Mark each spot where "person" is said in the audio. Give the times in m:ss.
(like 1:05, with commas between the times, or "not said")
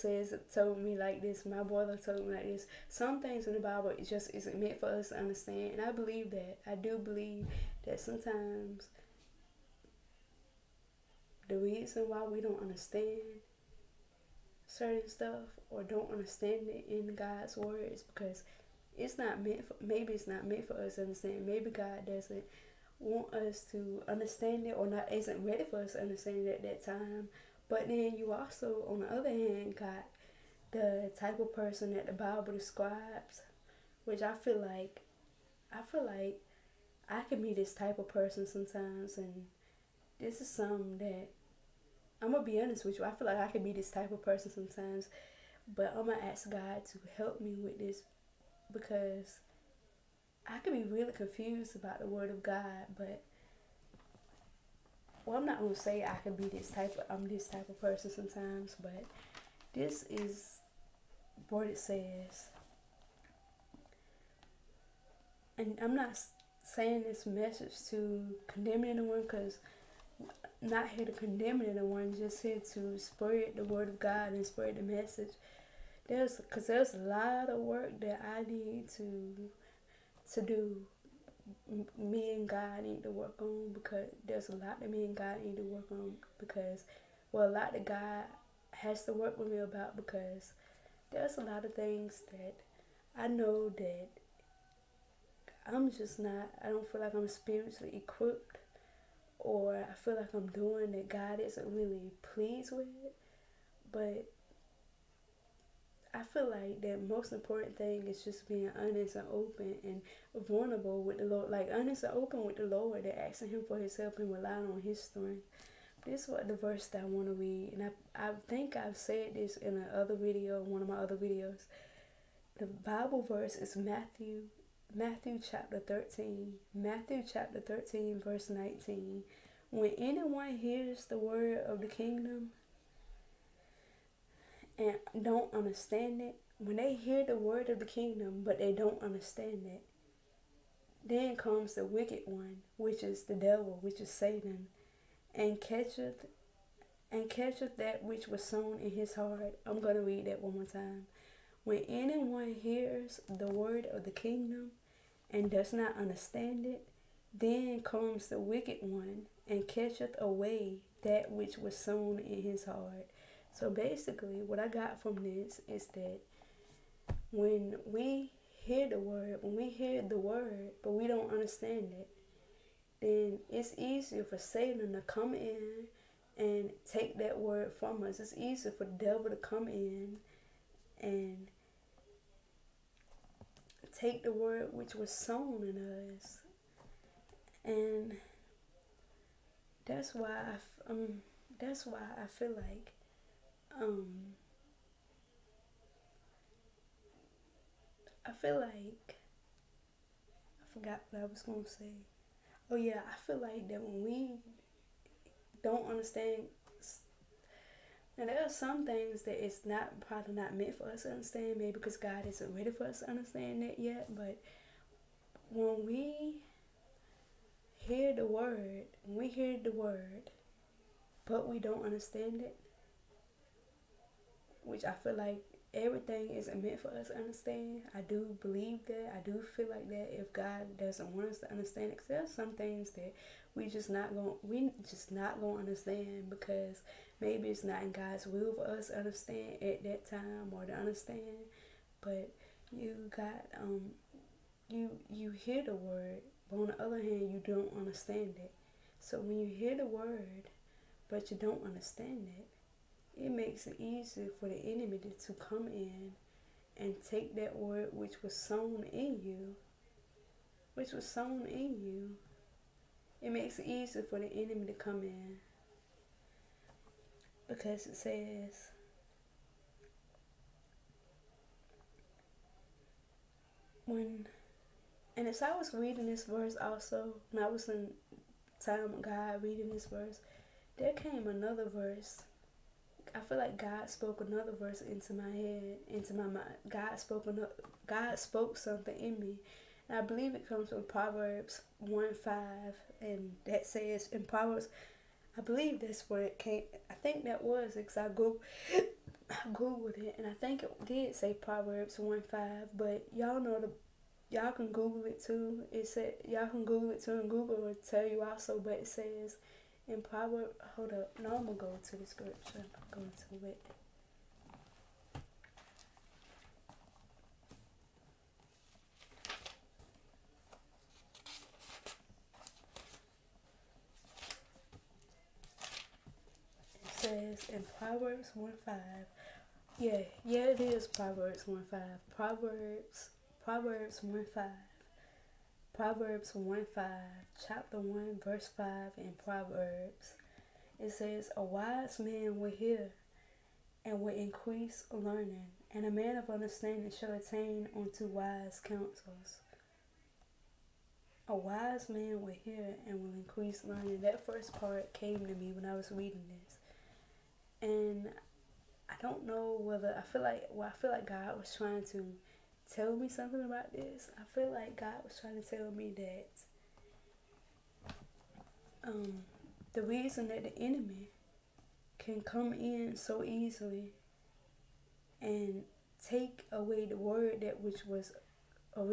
0:31, 0:38, 0:44, 0:57.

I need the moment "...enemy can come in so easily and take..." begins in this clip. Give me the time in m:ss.
6:10.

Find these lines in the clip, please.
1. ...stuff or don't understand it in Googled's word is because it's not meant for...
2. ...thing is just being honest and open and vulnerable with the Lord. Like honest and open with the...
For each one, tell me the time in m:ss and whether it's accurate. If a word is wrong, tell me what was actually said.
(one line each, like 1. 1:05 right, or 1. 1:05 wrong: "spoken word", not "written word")
1. 0:15 wrong: "God", not "Googled"
2. 1:47 right.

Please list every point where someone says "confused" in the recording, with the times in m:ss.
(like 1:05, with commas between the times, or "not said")
0:51.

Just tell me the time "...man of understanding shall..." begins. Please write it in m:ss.
5:45.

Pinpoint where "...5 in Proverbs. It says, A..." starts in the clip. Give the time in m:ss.
5:38.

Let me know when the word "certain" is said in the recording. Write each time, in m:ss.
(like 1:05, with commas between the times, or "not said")
0:14.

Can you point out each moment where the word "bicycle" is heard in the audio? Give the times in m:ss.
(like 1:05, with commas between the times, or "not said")
not said.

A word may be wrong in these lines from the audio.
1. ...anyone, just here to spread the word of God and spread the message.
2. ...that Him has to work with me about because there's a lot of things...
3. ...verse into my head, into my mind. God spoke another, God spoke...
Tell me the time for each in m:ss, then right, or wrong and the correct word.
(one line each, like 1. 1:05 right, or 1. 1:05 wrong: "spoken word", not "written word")
1. 1:11 right
2. 1:27 wrong: "God", not "Him"
3. 4:44 right.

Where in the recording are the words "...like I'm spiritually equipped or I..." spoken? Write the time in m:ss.
1:37.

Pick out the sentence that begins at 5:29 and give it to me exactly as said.
Yeah, yeah, it is Proverbs 1 5.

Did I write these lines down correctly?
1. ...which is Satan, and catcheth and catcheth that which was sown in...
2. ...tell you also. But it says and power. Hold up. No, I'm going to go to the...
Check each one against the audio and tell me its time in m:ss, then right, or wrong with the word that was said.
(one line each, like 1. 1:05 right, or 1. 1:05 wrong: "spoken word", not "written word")
1. 2:23 right
2. 5:07 right.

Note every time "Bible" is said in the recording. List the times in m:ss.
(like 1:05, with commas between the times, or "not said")
0:03, 0:32, 2:02.